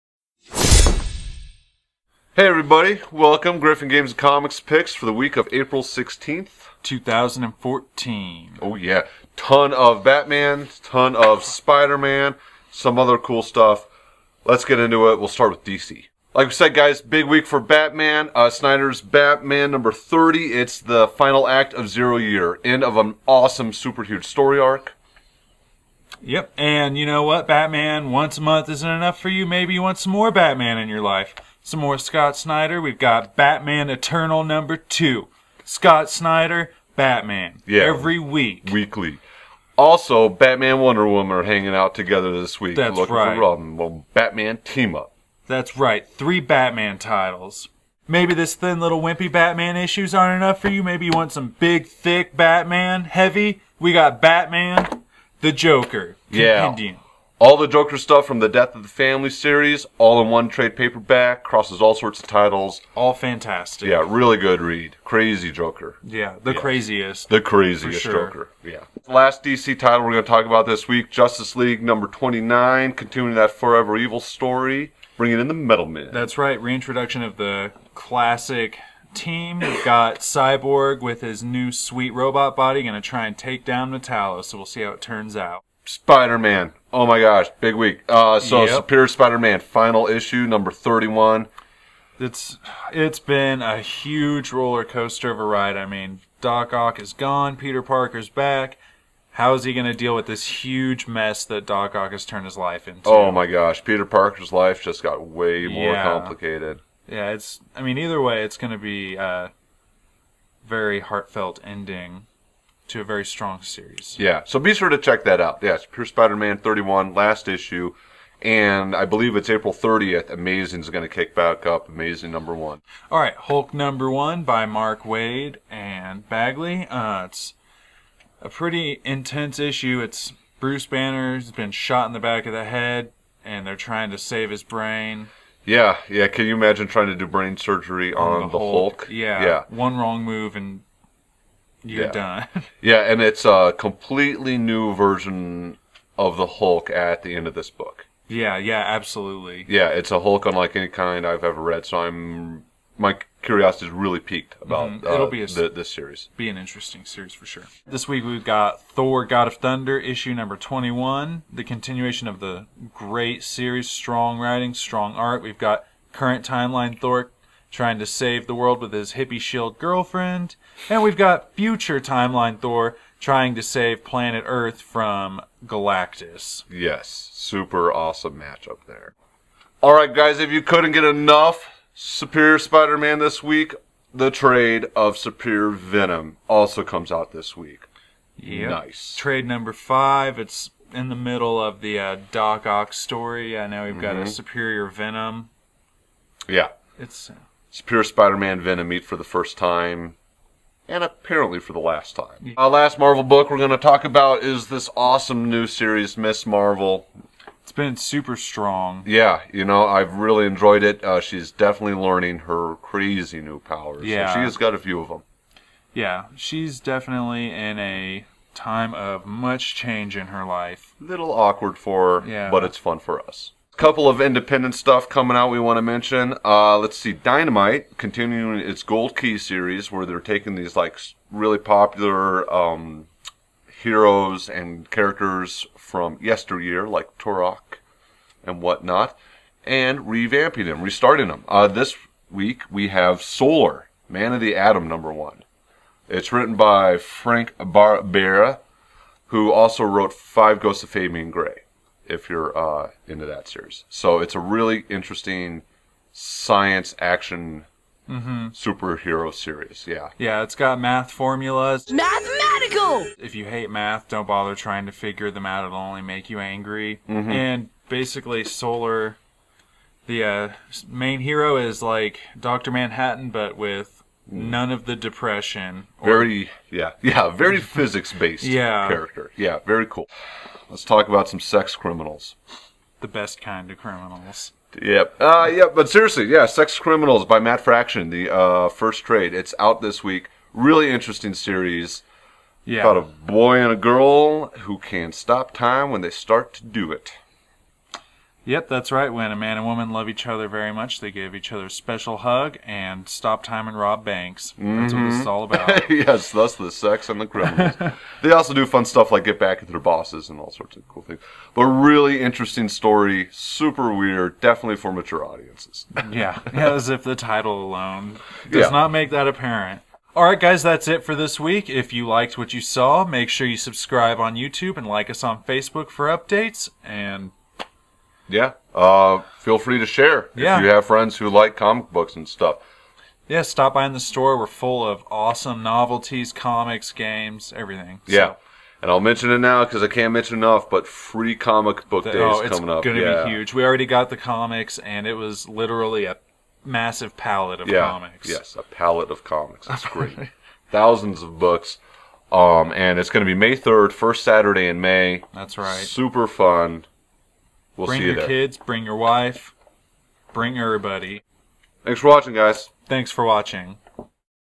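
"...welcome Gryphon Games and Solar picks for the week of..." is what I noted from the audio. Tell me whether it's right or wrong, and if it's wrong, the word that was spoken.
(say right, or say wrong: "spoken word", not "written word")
wrong: "Comics", not "Solar".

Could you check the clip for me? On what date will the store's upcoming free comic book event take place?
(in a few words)
May 3rd.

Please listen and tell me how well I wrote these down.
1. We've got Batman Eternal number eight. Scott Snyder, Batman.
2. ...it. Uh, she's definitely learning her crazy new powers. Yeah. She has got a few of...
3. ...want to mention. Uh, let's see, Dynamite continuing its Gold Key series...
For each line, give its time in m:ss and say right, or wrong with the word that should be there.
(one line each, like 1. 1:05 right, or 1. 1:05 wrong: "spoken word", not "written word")
1. 0:32 wrong: "two", not "eight"
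2. 3:30 right
3. 3:45 right.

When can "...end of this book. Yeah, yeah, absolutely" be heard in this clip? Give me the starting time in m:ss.
2:27.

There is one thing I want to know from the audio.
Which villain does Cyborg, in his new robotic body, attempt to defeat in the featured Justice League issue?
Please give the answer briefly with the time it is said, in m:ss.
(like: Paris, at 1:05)
Metallo, at 1:23.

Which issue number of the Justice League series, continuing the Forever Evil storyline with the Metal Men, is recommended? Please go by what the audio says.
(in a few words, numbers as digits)
29.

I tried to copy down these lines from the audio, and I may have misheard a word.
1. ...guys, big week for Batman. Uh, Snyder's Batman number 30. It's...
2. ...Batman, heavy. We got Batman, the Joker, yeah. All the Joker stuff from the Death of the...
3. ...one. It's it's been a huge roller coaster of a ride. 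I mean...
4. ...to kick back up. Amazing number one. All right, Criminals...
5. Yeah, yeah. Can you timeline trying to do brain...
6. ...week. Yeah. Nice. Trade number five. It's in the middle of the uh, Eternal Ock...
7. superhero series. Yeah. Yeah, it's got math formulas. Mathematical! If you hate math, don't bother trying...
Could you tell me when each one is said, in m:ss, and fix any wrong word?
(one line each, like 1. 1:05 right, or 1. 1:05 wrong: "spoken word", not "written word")
1. 0:16 right
2. 0:52 right
3. 1:31 right
4. 2:01 wrong: "Hulk", not "Criminals"
5. 2:15 wrong: "imagine", not "timeline"
6. 3:07 wrong: "Doc", not "Eternal"
7. 4:18 right.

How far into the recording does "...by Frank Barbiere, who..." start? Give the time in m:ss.
4:06.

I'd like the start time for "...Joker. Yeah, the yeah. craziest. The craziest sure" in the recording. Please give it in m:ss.
1:05.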